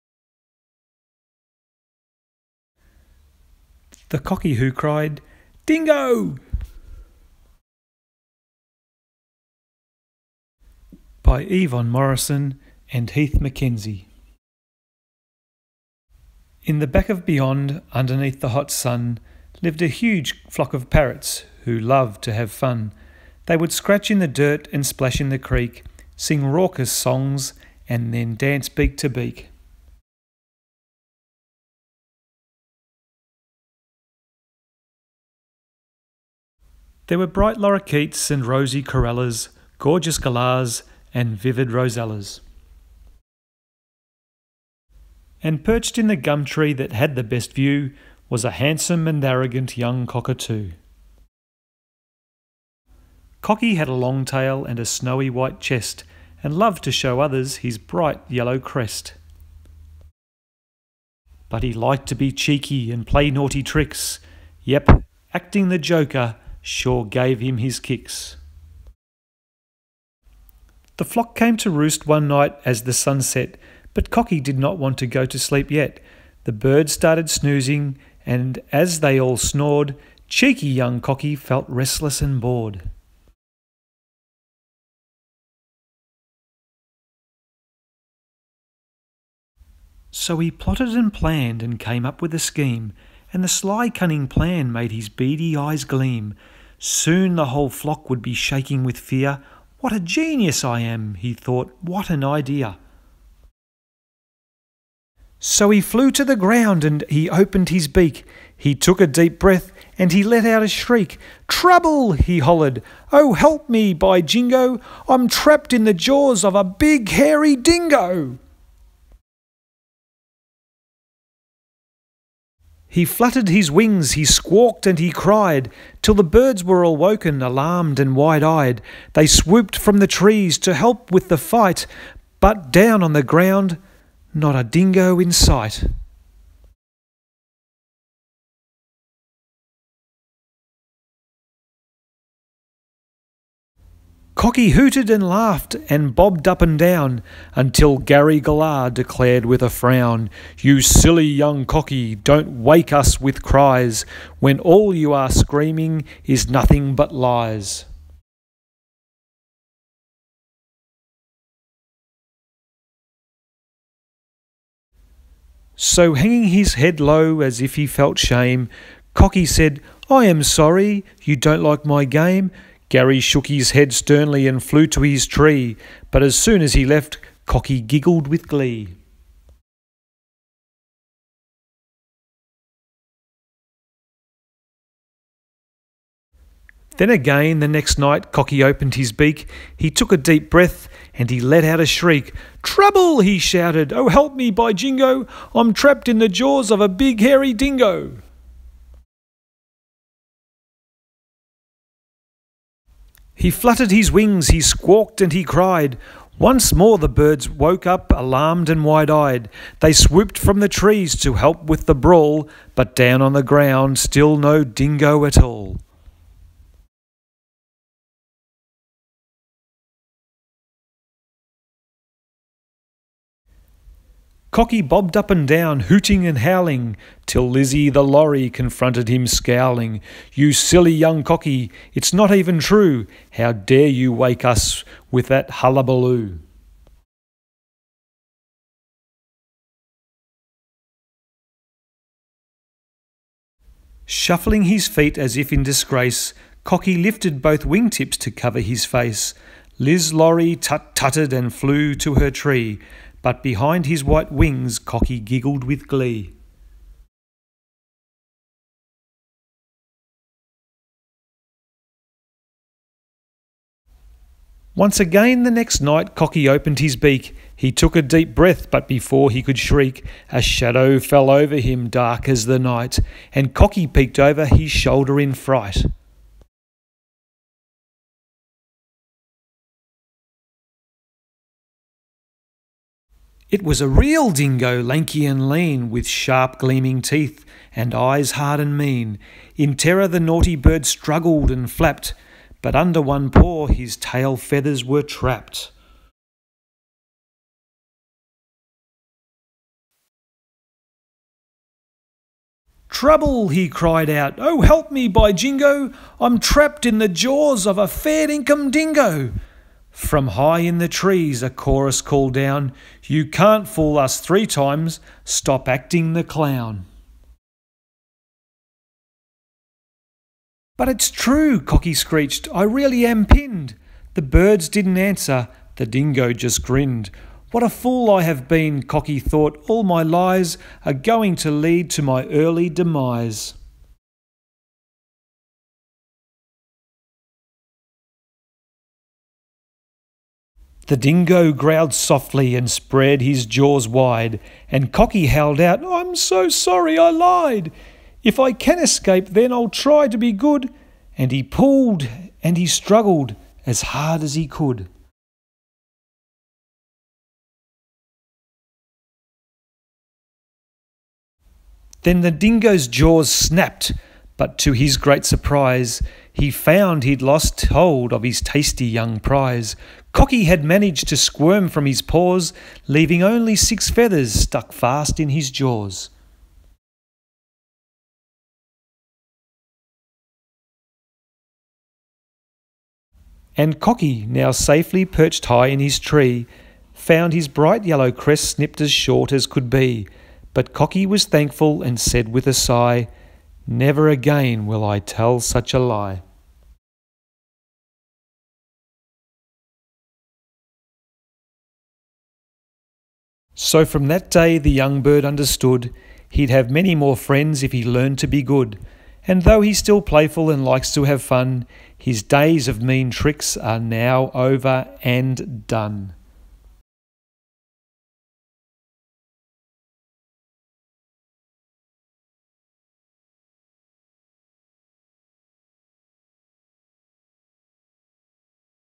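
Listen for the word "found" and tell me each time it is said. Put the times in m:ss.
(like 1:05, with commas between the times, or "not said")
6:06, 6:26.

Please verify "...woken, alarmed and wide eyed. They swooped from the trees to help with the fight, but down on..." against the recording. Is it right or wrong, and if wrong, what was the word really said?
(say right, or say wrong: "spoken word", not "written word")
right.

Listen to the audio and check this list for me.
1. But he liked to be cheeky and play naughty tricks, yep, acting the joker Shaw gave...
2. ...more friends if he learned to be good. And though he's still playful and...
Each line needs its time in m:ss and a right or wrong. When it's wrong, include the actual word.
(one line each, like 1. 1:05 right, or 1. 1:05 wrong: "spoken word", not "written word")
1. 1:01 right
2. 6:46 right.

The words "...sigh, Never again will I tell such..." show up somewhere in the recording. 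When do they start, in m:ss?
6:32.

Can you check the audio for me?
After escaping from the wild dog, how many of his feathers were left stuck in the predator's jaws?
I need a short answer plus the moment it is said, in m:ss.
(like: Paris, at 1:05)
6, at 6:13.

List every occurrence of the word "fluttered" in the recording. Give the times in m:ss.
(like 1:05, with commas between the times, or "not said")
2:03, 3:23.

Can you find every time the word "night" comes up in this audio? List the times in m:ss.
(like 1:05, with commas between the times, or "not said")
1:12, 3:07, 4:25, 4:32.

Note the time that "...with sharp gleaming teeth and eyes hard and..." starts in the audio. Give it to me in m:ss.
4:45.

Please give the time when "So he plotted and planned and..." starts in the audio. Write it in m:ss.
1:30.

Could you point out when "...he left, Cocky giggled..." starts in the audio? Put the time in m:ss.
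2:56.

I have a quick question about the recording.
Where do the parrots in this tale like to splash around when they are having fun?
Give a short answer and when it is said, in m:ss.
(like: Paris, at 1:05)
the creek, at 0:25.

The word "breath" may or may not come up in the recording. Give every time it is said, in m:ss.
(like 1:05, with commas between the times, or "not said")
1:49, 3:10, 4:28.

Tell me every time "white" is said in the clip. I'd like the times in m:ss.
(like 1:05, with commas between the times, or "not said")
0:55, 4:14.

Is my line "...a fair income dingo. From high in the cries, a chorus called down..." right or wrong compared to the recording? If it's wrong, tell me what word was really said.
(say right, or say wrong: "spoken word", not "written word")
wrong: "trees", not "cries".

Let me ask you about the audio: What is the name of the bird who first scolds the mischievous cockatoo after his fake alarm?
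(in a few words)
Gary Galah.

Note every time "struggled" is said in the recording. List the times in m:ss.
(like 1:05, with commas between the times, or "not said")
4:50, 5:52.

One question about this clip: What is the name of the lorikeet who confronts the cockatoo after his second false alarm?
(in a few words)
Lizzie.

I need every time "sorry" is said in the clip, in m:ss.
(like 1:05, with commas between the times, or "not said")
2:50, 5:46.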